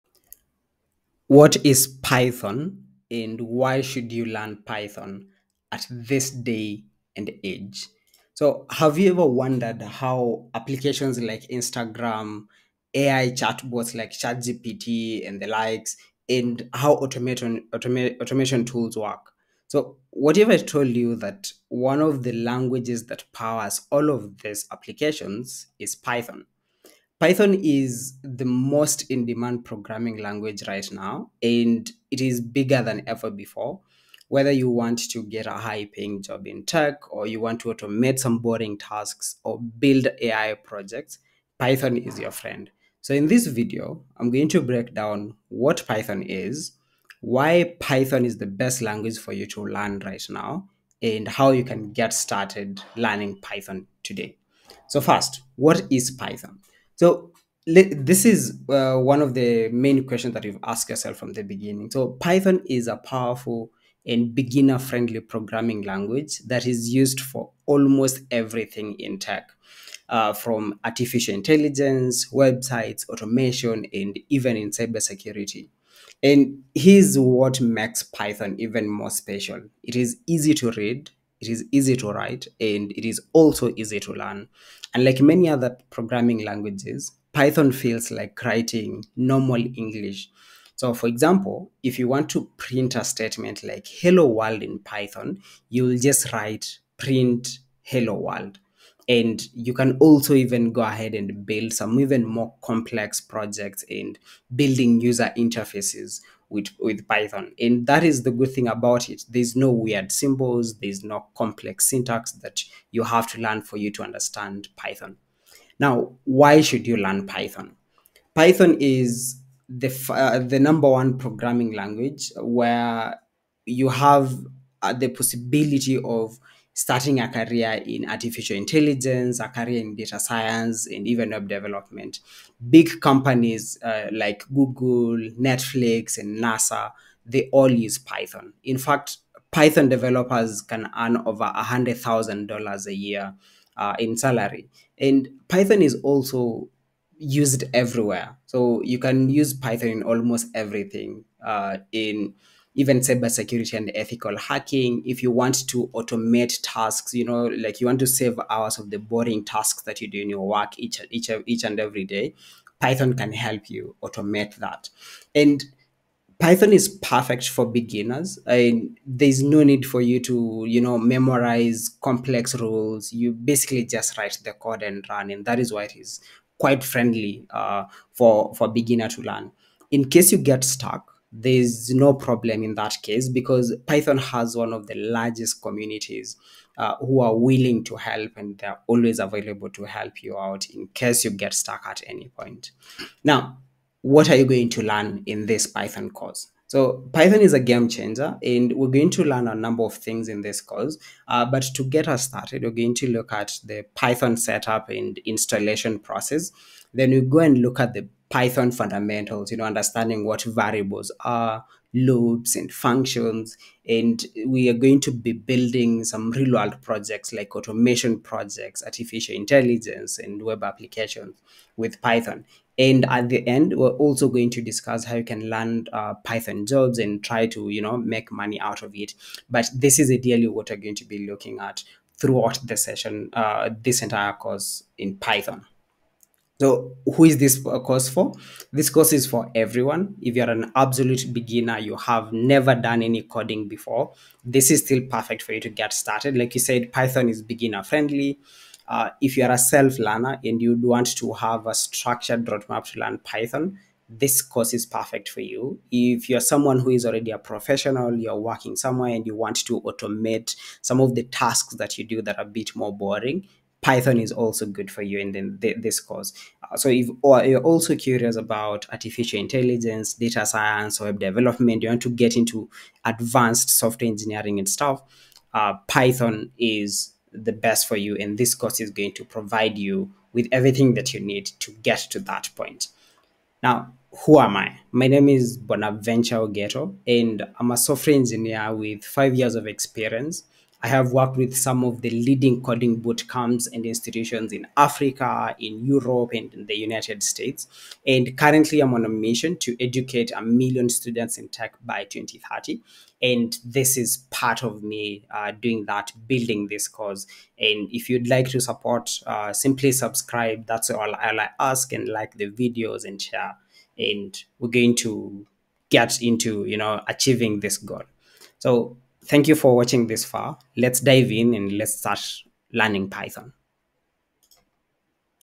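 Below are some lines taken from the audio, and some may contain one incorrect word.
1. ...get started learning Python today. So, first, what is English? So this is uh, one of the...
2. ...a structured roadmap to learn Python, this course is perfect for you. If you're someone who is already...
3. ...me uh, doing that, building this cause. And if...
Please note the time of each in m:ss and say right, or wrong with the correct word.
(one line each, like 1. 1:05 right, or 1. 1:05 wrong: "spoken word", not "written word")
1. 0:51 wrong: "Python", not "English"
2. 4:11 right
3. 5:04 right.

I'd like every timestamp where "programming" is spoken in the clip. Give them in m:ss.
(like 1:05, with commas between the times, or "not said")
0:29, 1:05, 1:25, 2:01.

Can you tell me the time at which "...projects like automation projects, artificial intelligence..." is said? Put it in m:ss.
3:36.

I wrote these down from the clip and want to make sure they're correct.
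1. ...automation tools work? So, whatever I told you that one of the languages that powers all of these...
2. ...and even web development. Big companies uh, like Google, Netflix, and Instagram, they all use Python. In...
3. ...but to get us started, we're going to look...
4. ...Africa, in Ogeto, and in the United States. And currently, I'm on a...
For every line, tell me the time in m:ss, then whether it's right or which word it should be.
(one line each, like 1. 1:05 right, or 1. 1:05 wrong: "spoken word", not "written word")
1. 0:18 right
2. 2:10 wrong: "NASA", not "Instagram"
3. 3:21 right
4. 4:54 wrong: "Europe", not "Ogeto".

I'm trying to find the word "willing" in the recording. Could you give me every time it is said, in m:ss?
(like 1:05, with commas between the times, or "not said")
3:07.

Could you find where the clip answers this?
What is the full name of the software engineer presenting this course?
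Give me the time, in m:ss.
4:45.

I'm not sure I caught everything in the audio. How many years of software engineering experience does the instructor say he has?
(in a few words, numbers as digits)
5.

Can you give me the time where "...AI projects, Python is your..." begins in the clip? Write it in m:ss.
0:40.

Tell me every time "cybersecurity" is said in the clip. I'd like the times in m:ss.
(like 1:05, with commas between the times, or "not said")
1:14, 2:32.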